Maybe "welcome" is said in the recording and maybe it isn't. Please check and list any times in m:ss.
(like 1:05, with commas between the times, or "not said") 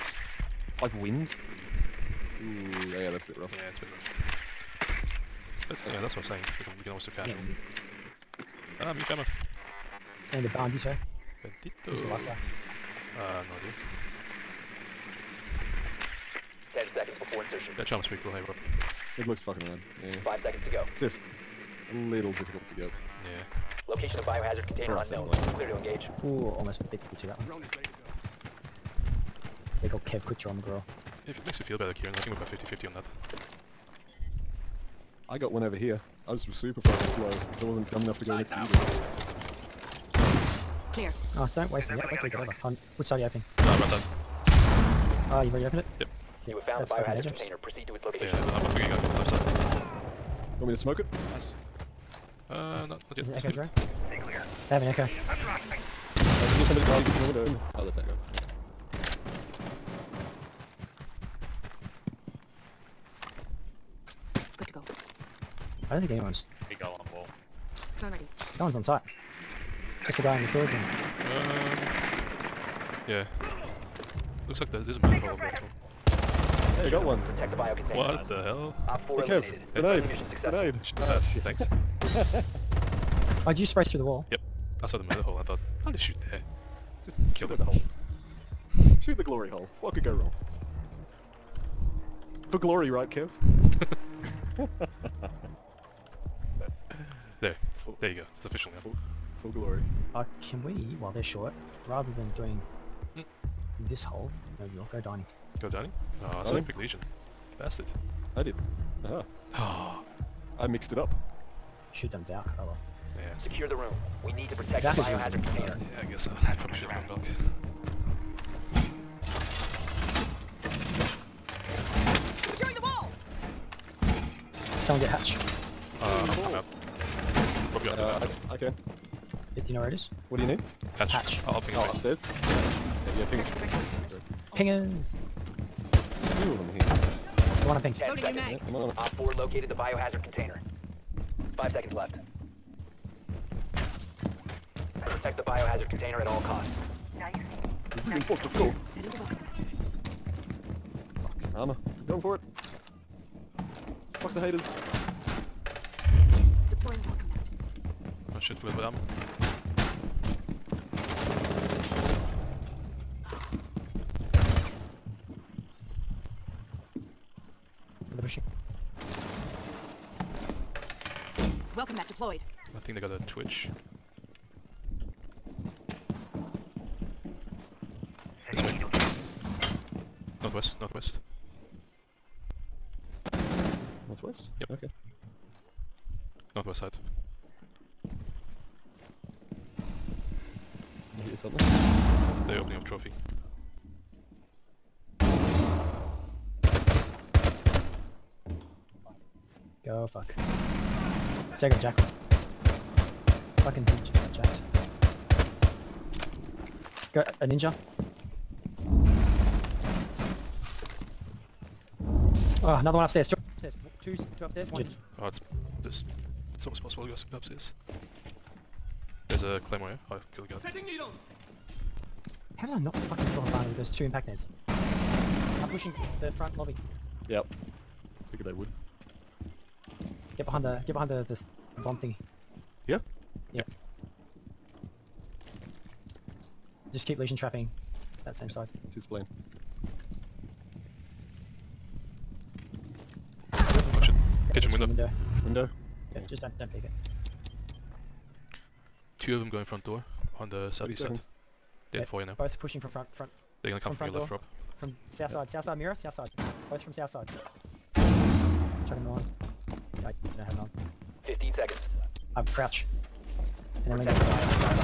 2:37, 2:51.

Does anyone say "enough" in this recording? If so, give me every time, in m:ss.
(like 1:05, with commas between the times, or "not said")
0:38.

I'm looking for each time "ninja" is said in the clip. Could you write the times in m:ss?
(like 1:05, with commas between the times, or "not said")
3:27.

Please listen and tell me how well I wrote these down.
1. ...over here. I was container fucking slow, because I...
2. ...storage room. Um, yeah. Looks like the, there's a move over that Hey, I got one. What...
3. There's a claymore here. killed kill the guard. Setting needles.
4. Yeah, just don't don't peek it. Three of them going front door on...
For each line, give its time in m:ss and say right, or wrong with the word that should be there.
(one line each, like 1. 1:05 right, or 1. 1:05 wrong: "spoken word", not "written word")
1. 0:35 wrong: "super", not "container"
2. 1:10 right
3. 3:39 right
4. 4:06 wrong: "Two", not "Three".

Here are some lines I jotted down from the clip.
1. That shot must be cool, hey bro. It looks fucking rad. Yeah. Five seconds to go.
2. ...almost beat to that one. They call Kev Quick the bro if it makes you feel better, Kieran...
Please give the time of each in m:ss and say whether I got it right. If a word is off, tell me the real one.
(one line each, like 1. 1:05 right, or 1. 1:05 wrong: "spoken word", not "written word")
1. 0:17 right
2. 0:26 right.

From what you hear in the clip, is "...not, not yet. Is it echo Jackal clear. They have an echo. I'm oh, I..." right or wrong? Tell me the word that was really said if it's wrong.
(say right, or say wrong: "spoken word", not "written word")
wrong: "Stay", not "Jackal".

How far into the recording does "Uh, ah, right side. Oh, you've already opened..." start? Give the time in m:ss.
0:43.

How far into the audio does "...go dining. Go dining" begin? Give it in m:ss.
1:44.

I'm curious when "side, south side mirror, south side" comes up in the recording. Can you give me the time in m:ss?
4:15.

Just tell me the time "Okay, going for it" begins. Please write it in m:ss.
2:31.